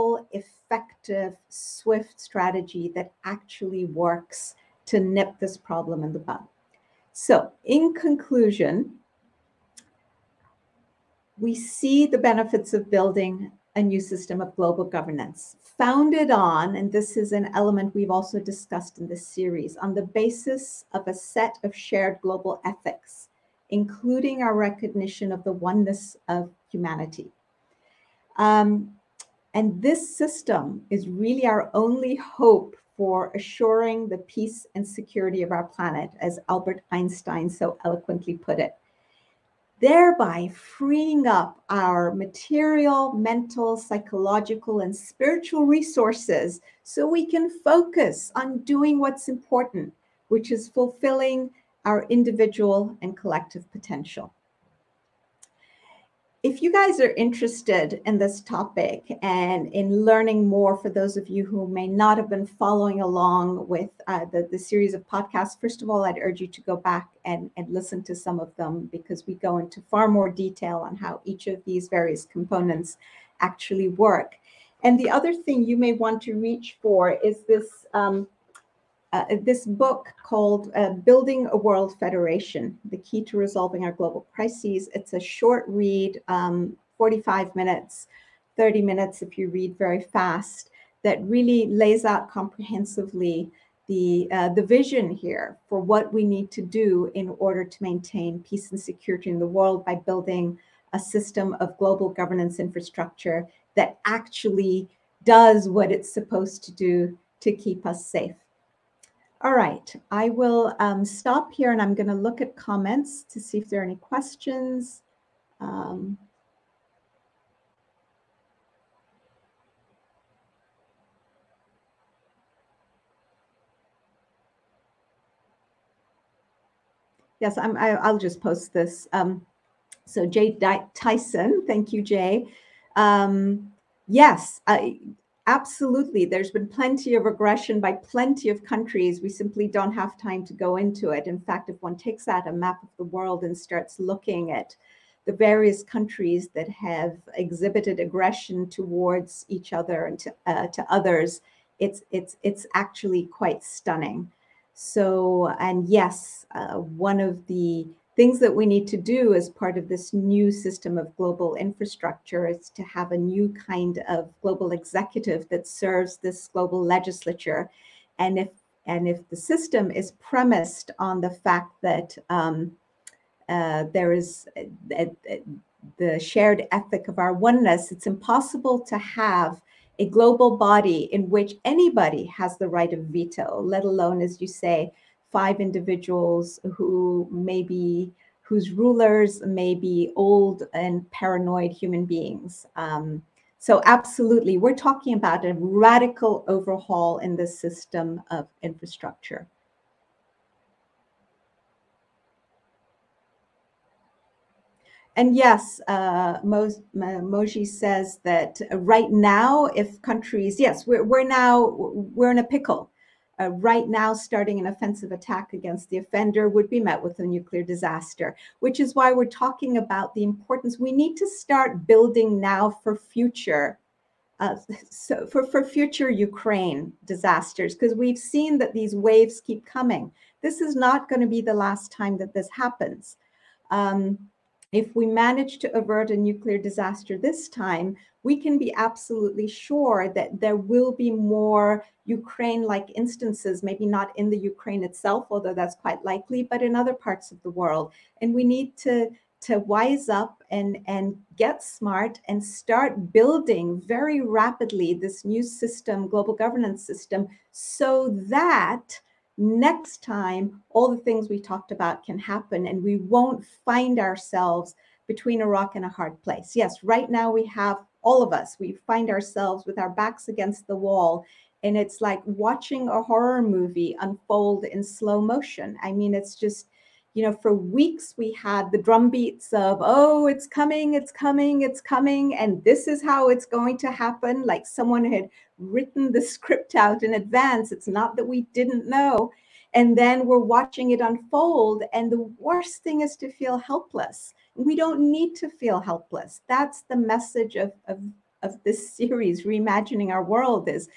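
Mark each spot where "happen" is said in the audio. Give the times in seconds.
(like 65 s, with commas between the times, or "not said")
232 s, 262 s, 283 s.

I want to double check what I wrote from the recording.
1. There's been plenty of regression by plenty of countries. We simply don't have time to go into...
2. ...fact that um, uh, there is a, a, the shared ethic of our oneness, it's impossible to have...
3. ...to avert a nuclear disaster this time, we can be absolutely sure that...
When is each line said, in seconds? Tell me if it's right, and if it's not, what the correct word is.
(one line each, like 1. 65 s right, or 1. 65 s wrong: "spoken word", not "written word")
1. 136 s right
2. 171 s right
3. 235 s right.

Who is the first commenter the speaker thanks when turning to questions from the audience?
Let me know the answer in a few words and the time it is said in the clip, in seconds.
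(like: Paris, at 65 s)
Jay Tyson, at 130 s.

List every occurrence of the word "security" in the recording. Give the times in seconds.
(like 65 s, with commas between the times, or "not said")
34 s, 98 s.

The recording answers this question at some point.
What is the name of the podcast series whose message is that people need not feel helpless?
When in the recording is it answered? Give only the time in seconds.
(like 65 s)
299 s.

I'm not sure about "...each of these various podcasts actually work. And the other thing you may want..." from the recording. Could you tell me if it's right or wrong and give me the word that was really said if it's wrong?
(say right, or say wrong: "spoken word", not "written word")
wrong: "components", not "podcasts".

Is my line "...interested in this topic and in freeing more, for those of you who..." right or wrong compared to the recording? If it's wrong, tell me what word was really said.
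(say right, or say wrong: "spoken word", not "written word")
wrong: "learning", not "freeing".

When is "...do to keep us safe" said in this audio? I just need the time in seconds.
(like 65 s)
106 s.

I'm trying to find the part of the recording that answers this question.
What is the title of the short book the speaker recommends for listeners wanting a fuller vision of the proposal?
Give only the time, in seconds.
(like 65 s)
80 s.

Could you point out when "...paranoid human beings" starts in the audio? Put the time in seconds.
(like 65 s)
191 s.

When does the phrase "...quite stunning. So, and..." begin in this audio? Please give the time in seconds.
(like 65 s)
153 s.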